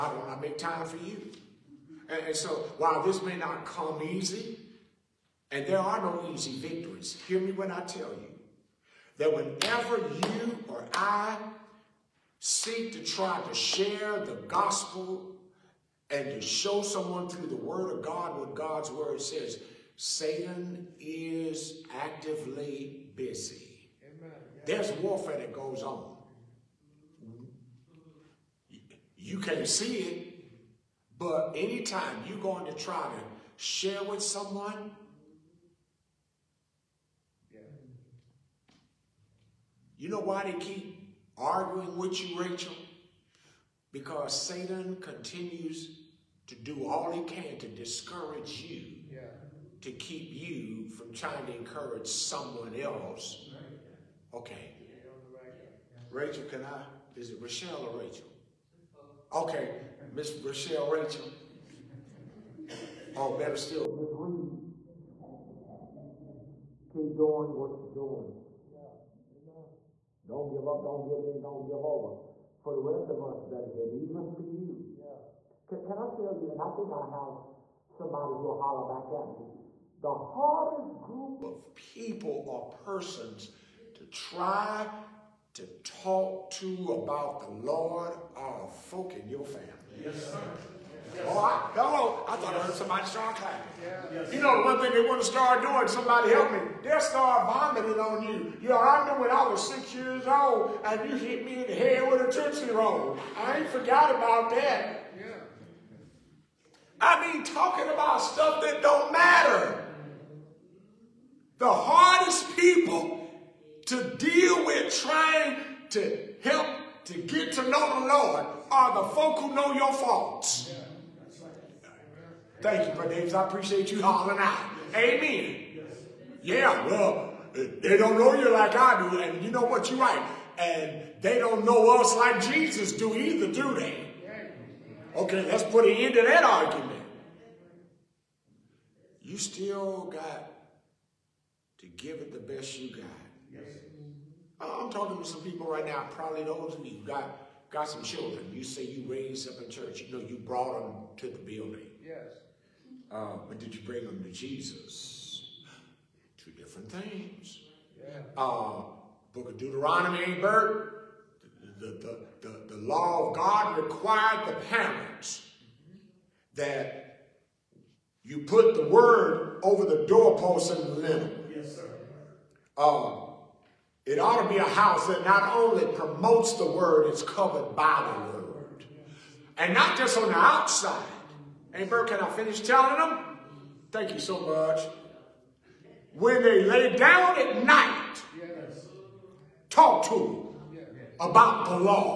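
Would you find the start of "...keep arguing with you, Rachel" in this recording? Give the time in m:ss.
0:40.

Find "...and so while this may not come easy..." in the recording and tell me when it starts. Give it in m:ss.
0:02.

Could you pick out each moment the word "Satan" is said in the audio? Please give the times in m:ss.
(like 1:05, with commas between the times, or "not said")
0:19, 0:44.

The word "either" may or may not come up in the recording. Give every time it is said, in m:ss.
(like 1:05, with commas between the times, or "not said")
2:13.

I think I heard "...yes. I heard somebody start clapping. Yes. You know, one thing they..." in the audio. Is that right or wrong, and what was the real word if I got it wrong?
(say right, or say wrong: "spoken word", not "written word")
right.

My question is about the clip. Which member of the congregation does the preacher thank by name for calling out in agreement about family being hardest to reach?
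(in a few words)
Brother Davis.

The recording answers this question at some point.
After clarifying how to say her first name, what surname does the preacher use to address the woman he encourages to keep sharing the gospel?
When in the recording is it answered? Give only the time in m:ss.
1:03.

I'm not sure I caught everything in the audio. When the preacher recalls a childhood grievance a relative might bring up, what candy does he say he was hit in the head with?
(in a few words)
Tootsie Roll.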